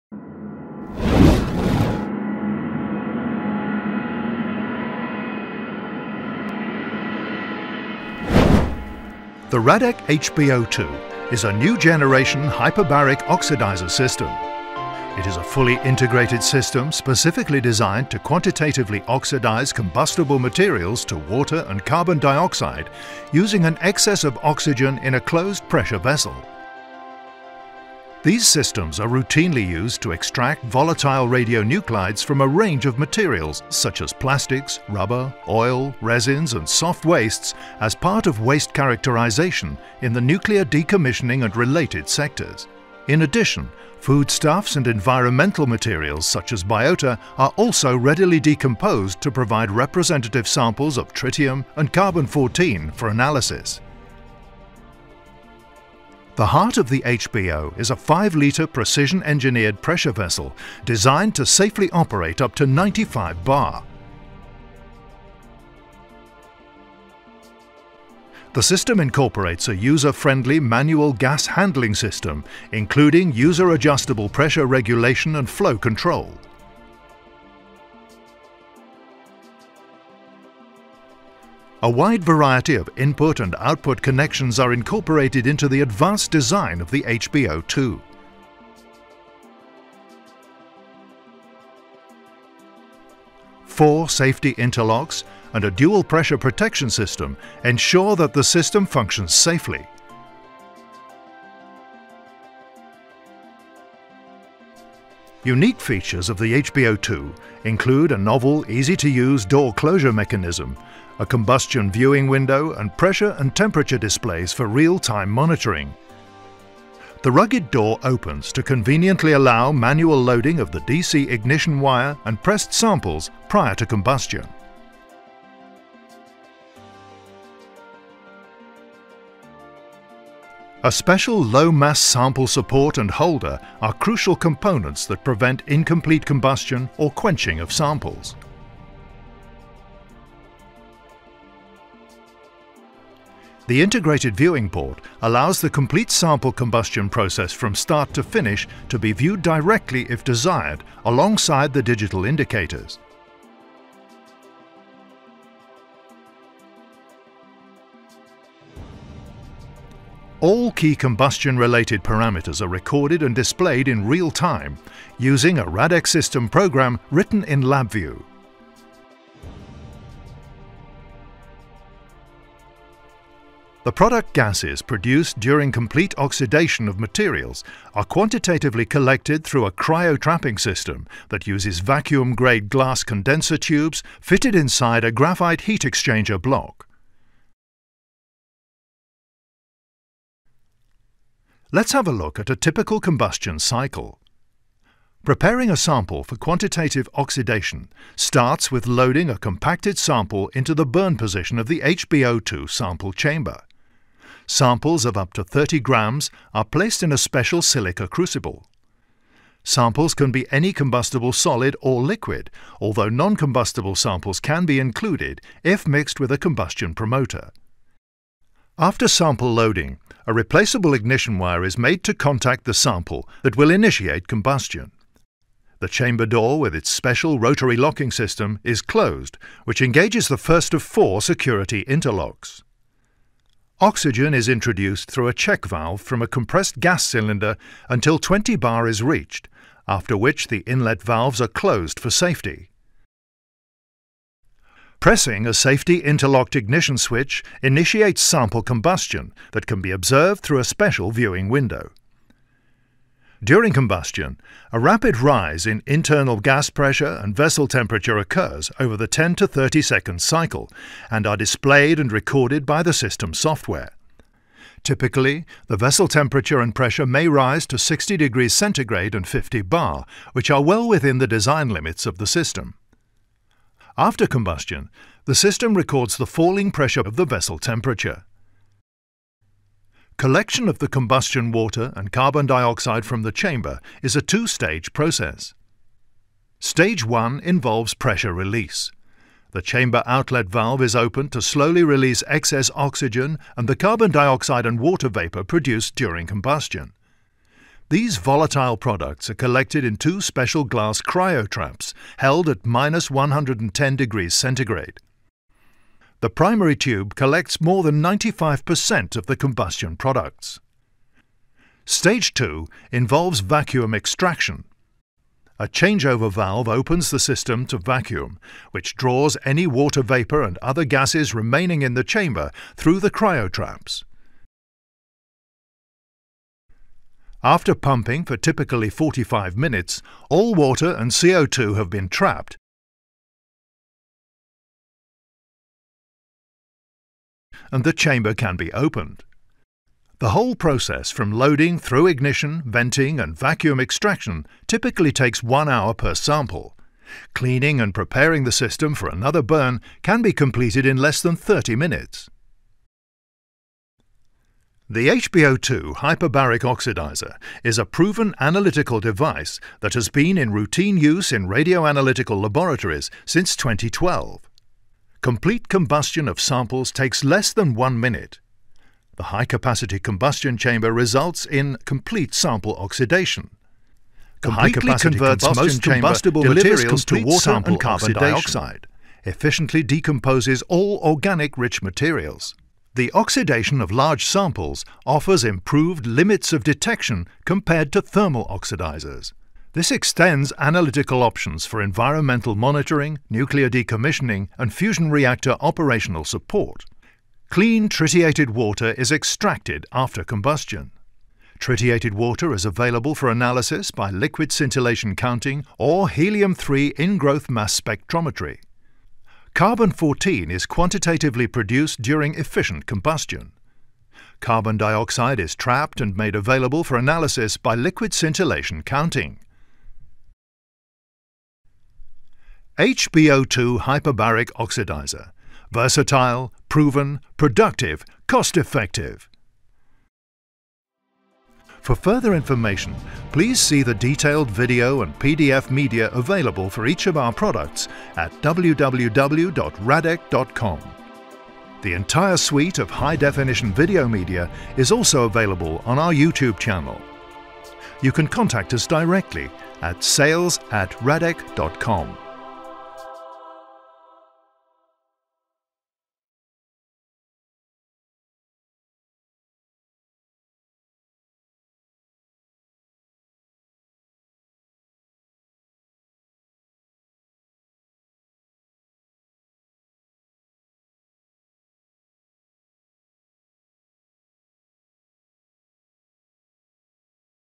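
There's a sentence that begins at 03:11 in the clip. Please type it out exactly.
Let's have a look at a typical combustion cycle.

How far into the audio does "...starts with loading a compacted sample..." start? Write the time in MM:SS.
03:18.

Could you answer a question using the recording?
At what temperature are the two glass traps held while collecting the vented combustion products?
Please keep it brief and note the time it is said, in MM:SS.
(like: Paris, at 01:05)
-110 °C, at 05:02.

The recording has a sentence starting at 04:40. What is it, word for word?
Collection of the combustion water and carbon dioxide from the chamber is a two-stage process.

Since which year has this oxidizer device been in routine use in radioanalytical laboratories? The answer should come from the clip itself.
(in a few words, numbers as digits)
2012.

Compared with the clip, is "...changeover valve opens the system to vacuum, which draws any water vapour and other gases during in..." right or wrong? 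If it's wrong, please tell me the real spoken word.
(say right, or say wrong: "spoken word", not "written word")
wrong: "remaining", not "during".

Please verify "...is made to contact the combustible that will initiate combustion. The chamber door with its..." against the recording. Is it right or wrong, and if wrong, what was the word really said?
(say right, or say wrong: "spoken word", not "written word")
wrong: "sample", not "combustible".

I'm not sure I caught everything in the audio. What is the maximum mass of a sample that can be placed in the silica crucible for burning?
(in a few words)
30 grams.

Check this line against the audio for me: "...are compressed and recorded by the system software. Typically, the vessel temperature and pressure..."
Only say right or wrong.
wrong.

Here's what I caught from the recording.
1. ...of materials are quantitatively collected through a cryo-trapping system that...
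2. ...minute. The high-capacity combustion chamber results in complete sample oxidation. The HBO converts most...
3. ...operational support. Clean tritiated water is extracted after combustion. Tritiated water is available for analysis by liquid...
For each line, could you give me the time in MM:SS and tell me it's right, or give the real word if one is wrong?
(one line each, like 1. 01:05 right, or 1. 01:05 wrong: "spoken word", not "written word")
1. 02:56 right
2. 06:08 wrong: "Completely", not "HBO"
3. 06:35 right.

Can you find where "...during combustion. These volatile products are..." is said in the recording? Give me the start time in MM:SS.
04:55.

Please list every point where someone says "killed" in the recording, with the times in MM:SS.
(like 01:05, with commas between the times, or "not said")
not said.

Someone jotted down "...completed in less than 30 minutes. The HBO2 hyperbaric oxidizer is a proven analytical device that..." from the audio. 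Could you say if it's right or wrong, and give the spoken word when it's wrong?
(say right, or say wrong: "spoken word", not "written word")
right.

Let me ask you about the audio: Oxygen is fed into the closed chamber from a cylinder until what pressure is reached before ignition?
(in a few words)
20 bar.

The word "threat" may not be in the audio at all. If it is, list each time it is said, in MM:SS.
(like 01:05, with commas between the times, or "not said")
not said.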